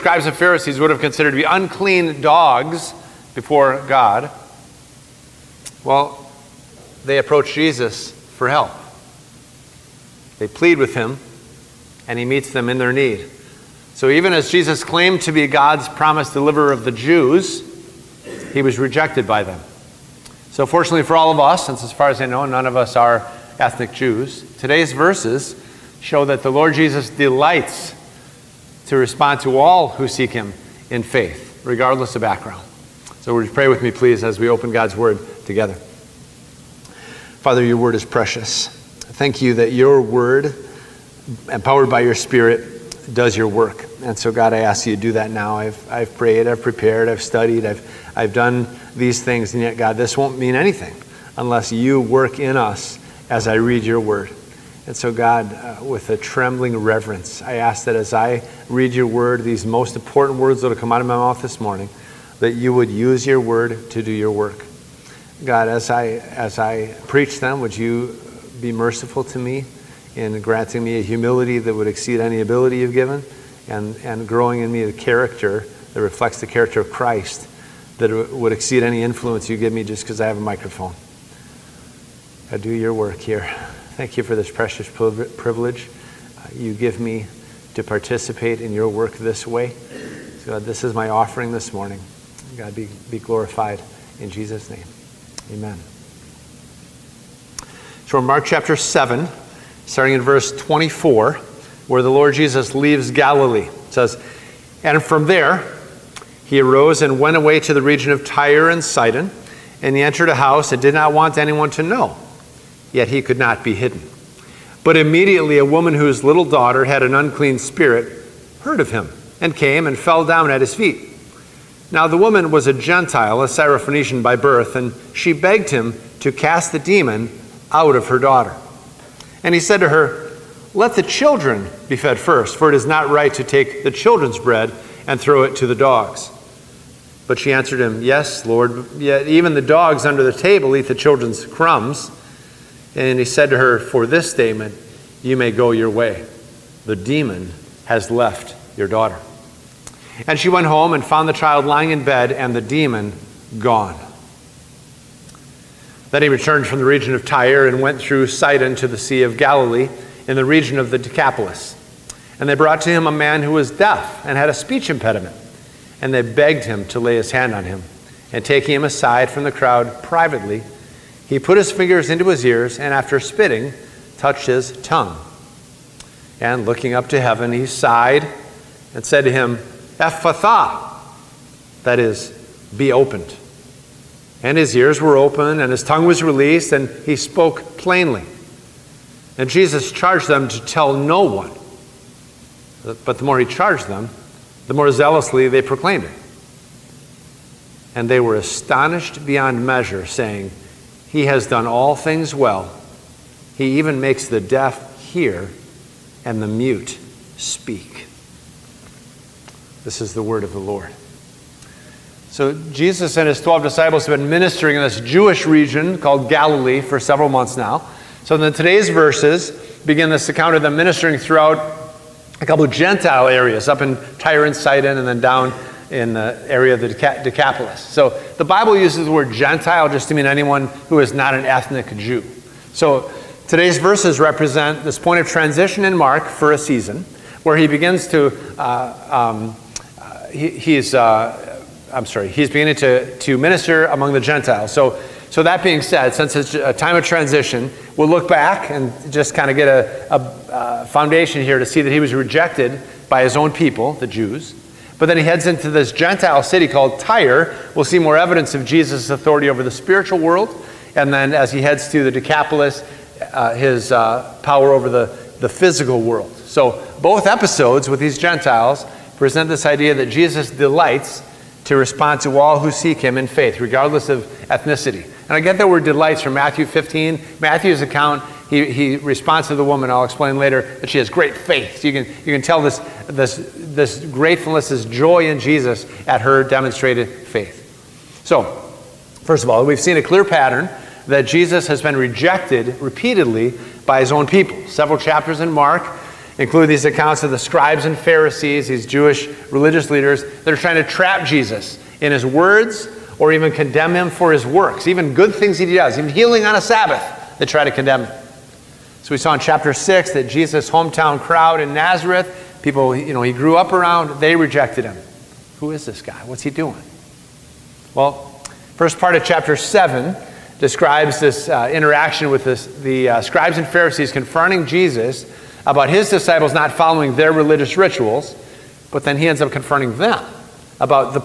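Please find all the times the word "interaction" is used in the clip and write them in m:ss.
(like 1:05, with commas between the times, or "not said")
5:21.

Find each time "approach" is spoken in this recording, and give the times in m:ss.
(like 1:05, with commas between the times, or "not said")
0:07.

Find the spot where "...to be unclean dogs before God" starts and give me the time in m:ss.
0:01.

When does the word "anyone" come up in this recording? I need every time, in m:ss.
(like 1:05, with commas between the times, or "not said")
1:51, 3:50.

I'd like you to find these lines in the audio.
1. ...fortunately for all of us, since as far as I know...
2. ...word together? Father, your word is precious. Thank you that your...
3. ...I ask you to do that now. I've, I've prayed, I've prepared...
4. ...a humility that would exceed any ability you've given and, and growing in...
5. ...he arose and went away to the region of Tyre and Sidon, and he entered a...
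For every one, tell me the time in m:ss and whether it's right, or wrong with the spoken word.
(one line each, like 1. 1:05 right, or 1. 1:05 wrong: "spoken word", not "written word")
1. 0:20 right
2. 0:34 right
3. 0:44 right
4. 1:11 right
5. 1:46 right.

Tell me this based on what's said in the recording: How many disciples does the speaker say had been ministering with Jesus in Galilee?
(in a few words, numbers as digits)
12.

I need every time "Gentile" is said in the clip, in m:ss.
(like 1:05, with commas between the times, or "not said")
2:02, 3:42, 3:49, 4:04, 4:15, 4:28.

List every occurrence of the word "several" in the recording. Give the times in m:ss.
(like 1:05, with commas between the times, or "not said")
3:37, 4:54.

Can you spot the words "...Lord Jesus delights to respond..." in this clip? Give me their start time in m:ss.
0:26.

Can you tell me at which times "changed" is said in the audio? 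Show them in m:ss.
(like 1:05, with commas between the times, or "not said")
not said.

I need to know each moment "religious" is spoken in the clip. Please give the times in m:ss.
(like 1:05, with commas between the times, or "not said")
4:59, 5:27.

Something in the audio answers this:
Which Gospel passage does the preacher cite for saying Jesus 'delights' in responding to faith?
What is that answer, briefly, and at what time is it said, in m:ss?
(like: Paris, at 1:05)
Matthew 15, at 4:36.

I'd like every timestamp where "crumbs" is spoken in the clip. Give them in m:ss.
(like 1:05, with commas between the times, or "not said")
2:21.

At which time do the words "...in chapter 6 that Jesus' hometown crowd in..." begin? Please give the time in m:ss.
5:09.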